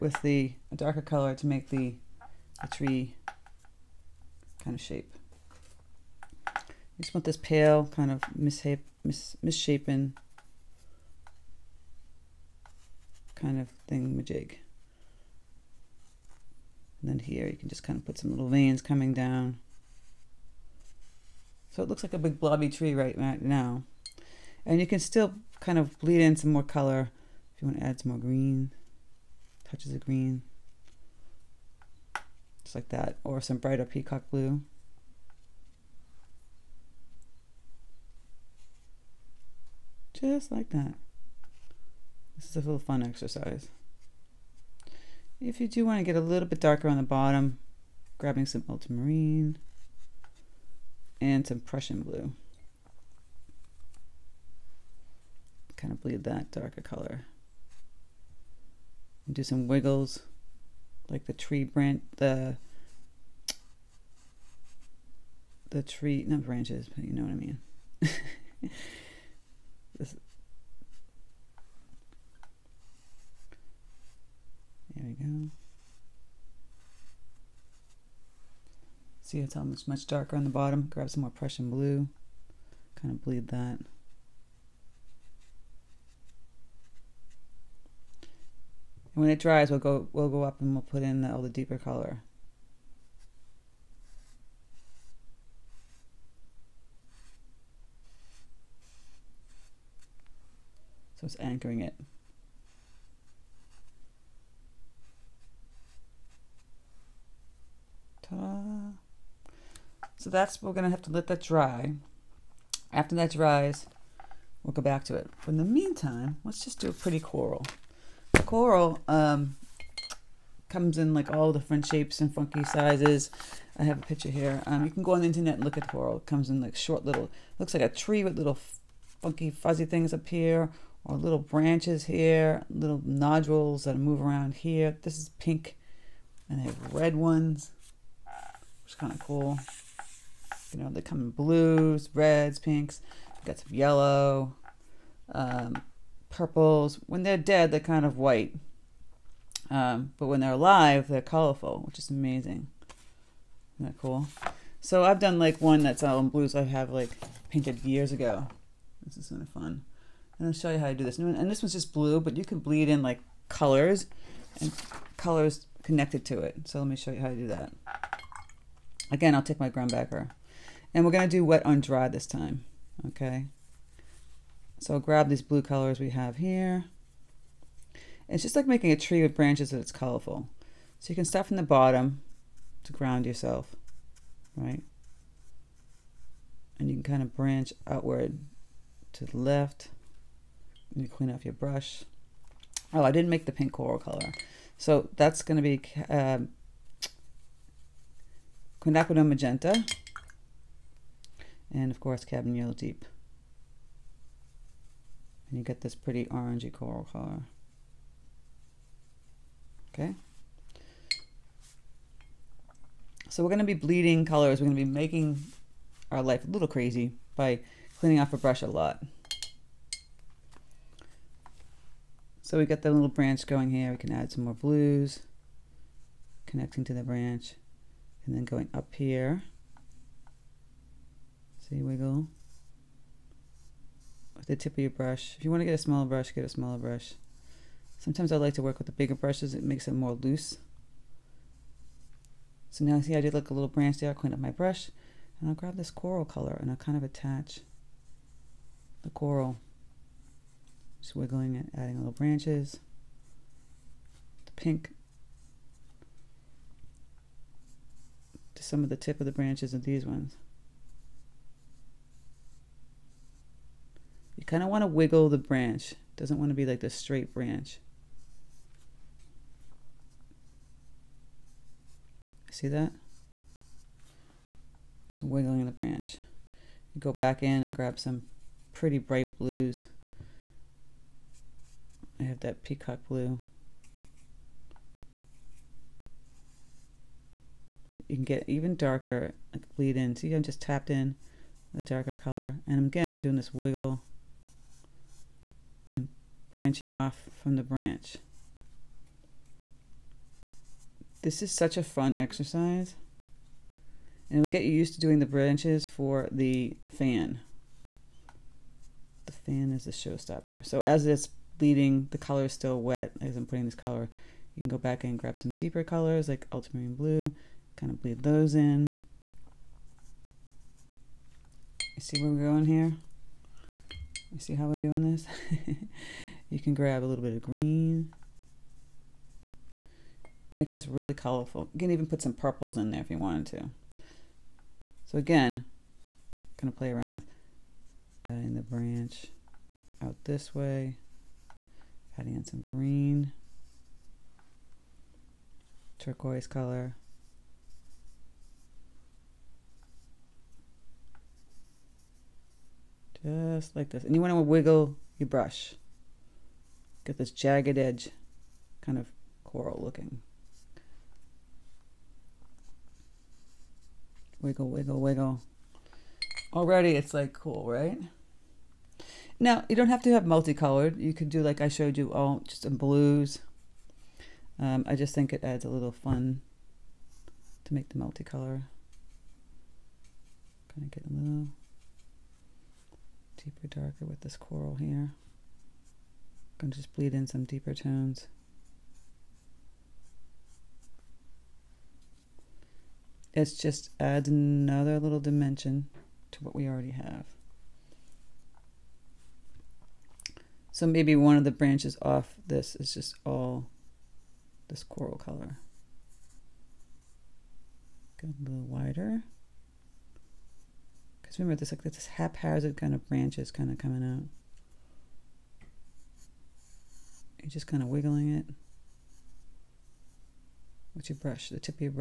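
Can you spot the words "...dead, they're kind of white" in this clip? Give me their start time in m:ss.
2:27.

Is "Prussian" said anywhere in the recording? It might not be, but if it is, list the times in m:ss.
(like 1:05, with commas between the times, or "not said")
0:51, 1:21.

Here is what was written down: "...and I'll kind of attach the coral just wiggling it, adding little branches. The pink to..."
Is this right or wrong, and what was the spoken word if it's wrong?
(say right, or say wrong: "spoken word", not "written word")
right.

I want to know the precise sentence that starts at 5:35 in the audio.
So again, kind of play around with adding uh, the branch out this way.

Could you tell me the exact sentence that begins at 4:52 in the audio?
And again, I'm doing this wiggle and branching off from the branch.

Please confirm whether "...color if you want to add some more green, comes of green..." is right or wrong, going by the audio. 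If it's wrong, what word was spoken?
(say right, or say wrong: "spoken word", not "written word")
wrong: "touches", not "comes".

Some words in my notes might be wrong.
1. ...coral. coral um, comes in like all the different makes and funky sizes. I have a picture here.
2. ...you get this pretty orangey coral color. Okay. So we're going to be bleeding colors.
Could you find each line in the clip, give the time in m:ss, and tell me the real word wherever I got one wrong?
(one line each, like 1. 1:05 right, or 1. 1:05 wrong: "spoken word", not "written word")
1. 1:57 wrong: "shapes", not "makes"
2. 3:25 right.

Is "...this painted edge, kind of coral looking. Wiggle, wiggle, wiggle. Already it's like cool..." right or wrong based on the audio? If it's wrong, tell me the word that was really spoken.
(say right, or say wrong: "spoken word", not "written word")
wrong: "jagged", not "painted".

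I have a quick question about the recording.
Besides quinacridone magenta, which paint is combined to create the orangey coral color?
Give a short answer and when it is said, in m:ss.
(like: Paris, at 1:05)
Cabernet Deep, at 3:22.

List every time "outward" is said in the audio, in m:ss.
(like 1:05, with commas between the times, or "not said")
3:07.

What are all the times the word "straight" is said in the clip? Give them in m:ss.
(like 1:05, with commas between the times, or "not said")
4:26.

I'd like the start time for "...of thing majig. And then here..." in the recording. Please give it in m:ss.
0:13.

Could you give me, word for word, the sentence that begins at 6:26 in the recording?
Gonna just bleed in some deeper tones.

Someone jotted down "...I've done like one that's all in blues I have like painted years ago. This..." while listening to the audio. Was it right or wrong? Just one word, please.
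right.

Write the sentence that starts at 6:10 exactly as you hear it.
You could do like I showed you all, just in blues.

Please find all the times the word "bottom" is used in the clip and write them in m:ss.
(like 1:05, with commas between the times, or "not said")
0:47, 1:20, 3:01.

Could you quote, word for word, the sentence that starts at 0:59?
And do some wiggles, like the tree branch, the the tree, not branches, but you know what I mean.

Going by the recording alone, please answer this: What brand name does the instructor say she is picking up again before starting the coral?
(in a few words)
Grumbacher.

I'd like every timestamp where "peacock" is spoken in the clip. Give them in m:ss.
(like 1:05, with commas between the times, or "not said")
0:33, 4:42.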